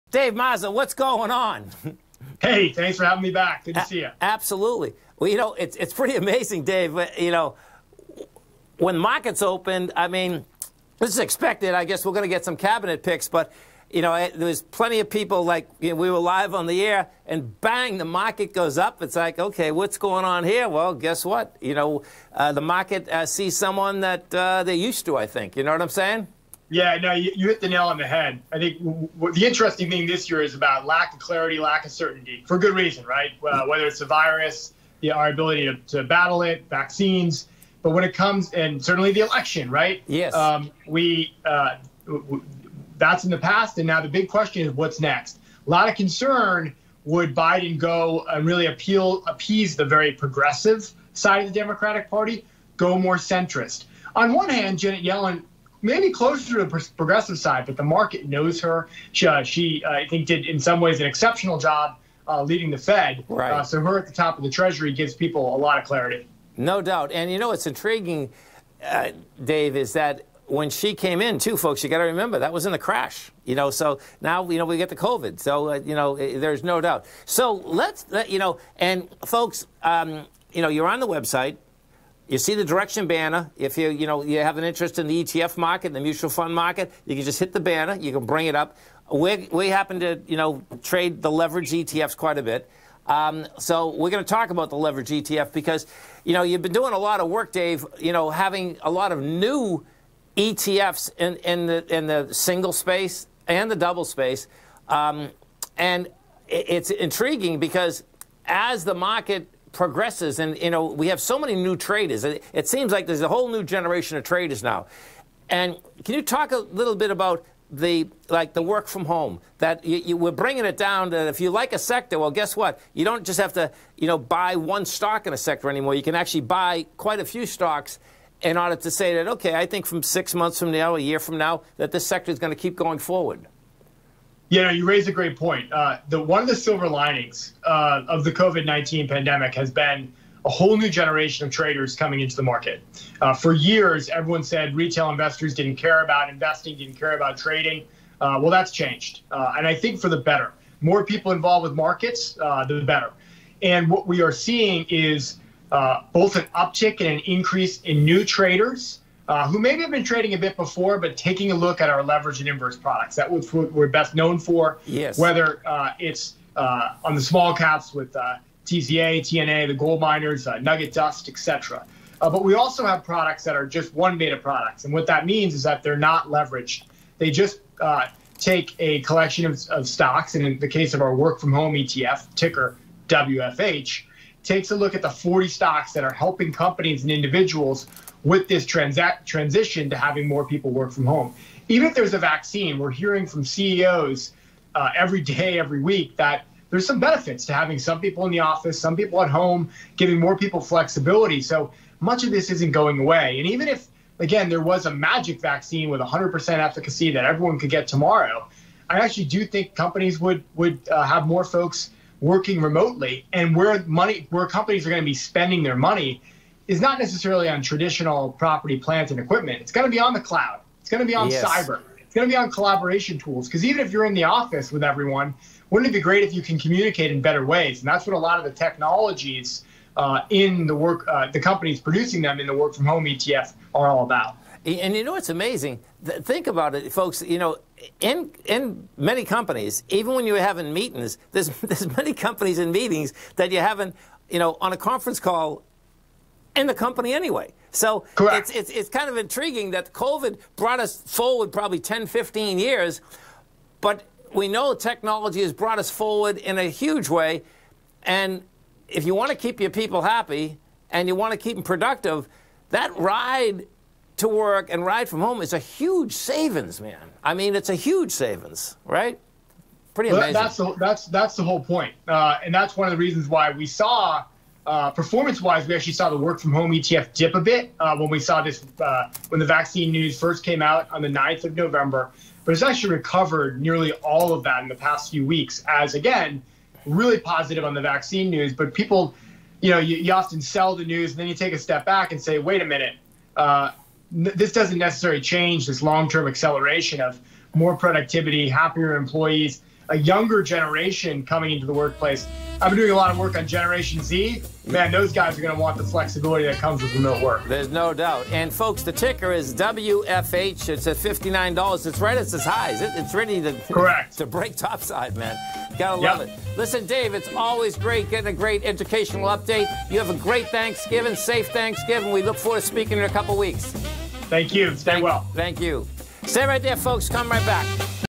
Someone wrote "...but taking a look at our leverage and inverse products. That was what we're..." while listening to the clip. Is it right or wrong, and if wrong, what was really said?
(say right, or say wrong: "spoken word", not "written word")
right.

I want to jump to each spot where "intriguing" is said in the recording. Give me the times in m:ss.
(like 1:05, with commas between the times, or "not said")
1:07, 1:46, 4:09.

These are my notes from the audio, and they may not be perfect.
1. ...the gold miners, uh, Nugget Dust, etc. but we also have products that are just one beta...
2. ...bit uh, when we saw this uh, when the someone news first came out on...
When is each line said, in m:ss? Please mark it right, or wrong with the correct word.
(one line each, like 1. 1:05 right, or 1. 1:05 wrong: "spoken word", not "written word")
1. 2:49 right
2. 4:37 wrong: "vaccine", not "someone".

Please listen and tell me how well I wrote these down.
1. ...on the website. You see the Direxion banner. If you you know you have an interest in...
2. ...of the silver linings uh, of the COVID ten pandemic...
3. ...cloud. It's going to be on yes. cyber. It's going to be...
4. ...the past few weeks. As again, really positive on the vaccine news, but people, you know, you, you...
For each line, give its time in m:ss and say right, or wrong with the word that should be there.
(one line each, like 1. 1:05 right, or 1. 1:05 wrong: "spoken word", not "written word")
1. 1:20 right
2. 2:16 wrong: "nineteen", not "ten"
3. 3:40 right
4. 4:44 right.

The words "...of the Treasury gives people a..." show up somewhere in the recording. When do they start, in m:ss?
1:04.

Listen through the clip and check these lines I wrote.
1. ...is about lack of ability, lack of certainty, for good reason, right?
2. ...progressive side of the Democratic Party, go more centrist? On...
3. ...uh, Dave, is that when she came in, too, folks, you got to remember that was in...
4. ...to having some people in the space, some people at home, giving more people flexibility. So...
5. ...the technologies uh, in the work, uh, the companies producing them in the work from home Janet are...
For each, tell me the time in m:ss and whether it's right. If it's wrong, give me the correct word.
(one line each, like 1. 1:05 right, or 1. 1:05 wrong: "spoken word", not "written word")
1. 0:30 wrong: "clarity", not "ability"
2. 0:50 right
3. 1:08 right
4. 3:17 wrong: "office", not "space"
5. 3:48 wrong: "ETF", not "Janet".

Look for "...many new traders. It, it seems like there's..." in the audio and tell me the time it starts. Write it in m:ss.
1:51.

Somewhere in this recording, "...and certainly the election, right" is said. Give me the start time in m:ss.
0:38.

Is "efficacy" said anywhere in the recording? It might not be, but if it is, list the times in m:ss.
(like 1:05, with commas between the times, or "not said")
3:26.